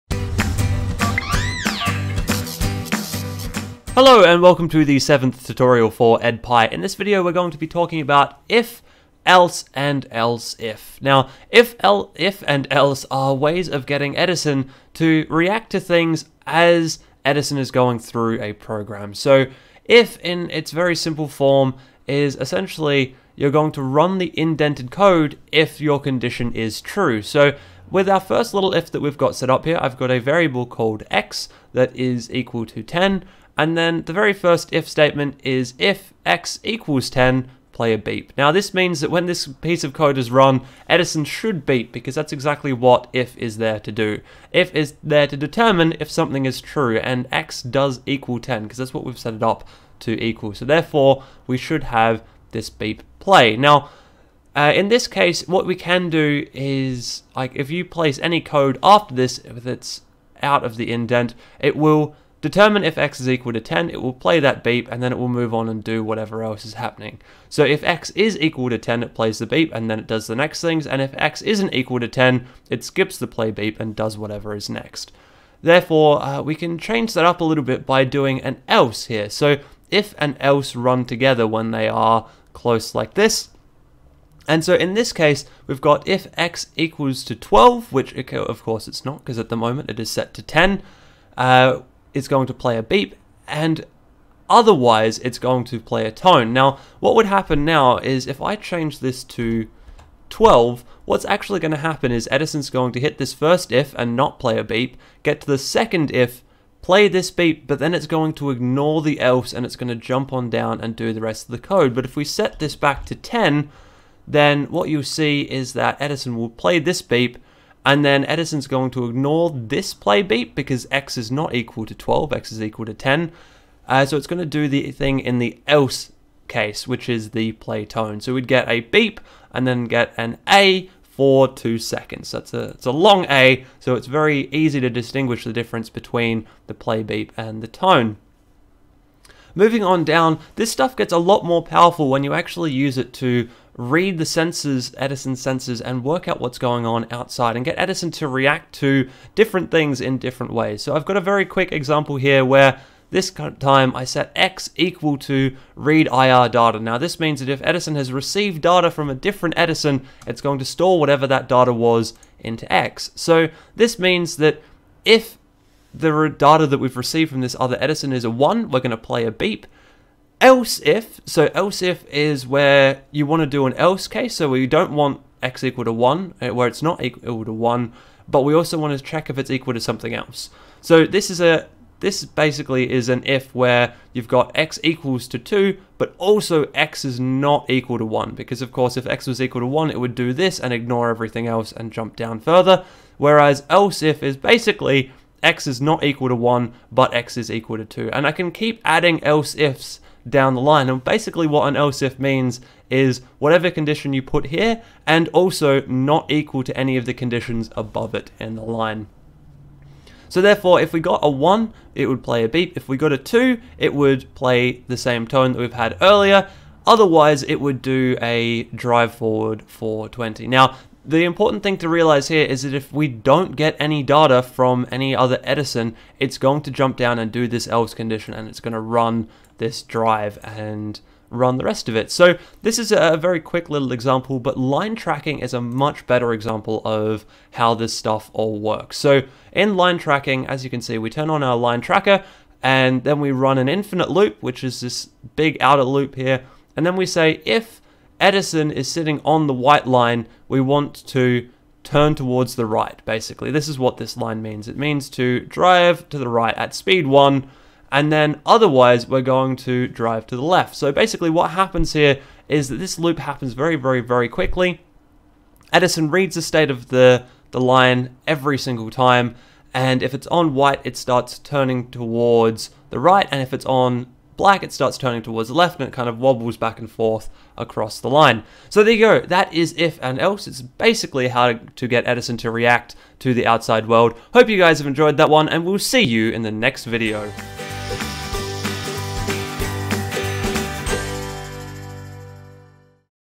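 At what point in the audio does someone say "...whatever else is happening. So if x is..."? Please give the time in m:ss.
1:06.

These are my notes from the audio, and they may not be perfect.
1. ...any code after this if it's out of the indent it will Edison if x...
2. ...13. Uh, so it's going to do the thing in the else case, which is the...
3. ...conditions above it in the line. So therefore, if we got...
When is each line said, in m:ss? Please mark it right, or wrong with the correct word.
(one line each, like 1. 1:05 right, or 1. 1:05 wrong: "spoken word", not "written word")
1. 0:58 wrong: "Determine", not "Edison"
2. 2:02 wrong: "10", not "13"
3. 3:27 right.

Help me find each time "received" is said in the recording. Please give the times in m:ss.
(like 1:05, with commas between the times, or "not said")
2:38, 2:46.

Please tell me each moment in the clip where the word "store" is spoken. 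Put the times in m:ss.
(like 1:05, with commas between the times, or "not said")
2:40.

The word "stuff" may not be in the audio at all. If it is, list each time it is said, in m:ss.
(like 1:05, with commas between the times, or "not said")
2:20, 3:57.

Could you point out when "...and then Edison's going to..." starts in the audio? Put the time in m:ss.
1:57.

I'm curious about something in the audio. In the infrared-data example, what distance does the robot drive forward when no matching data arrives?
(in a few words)
20.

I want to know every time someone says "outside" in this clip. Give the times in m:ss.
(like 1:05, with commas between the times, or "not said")
2:27, 4:43.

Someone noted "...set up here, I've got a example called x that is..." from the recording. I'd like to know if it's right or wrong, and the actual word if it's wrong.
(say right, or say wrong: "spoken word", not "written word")
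wrong: "variable", not "example".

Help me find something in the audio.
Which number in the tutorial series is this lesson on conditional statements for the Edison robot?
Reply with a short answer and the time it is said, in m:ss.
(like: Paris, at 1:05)
7th, at 0:04.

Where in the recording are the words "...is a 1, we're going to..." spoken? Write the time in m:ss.
2:48.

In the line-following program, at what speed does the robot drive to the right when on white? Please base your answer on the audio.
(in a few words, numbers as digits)
1.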